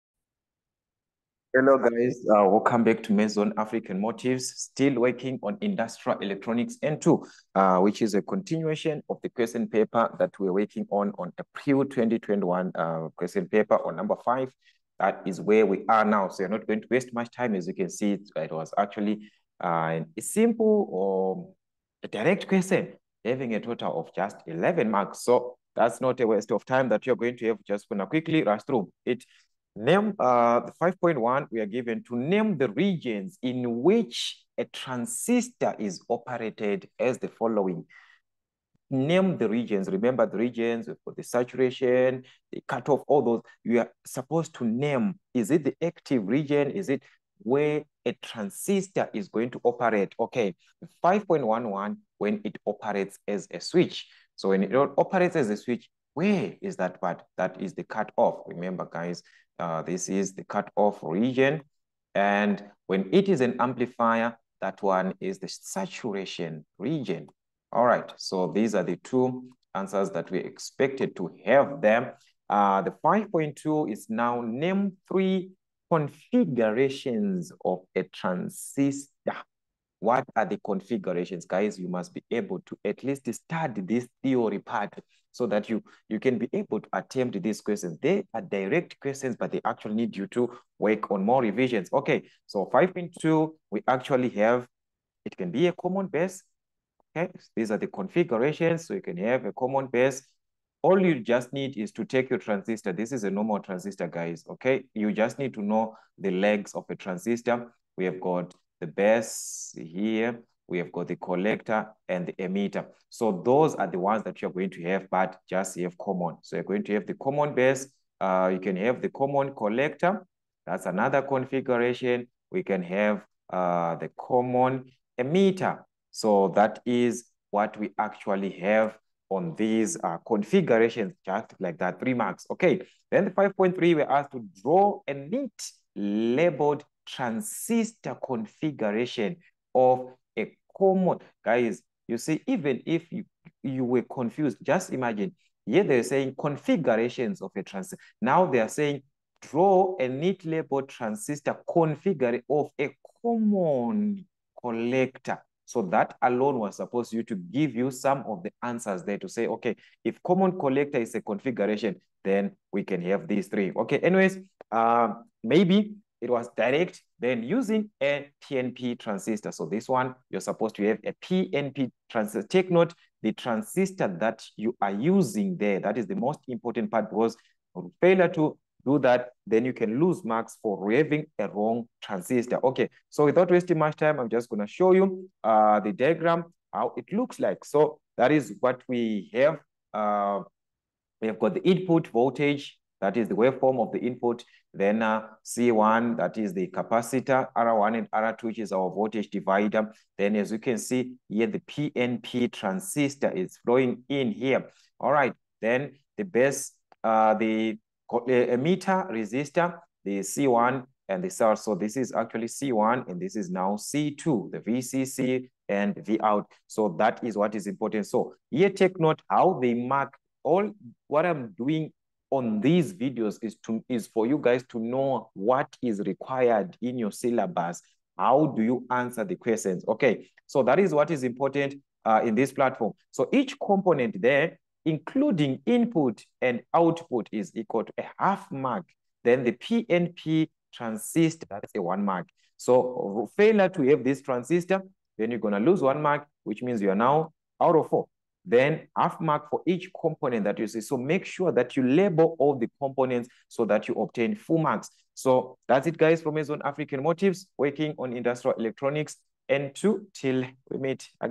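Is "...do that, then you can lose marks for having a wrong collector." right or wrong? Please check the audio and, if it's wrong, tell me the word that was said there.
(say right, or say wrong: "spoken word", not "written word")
wrong: "transistor", not "collector".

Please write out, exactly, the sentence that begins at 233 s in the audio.
So each component there, including input and output, is equal to a half mark.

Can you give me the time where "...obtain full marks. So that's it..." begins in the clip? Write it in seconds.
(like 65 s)
253 s.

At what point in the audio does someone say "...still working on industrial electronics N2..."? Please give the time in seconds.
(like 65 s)
4 s.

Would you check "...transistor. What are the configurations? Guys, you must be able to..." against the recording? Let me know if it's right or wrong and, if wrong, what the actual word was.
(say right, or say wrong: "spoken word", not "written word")
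right.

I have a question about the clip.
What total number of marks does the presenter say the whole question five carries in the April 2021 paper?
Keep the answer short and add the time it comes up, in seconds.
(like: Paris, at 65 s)
11, at 24 s.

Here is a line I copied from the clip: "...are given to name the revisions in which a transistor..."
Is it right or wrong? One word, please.
wrong.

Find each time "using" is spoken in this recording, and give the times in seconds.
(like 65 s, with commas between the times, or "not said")
167 s, 174 s.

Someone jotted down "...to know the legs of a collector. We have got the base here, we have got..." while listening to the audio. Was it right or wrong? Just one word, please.
wrong.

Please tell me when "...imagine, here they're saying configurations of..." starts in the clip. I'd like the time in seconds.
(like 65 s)
144 s.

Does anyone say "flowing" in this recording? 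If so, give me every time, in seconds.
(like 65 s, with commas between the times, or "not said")
203 s.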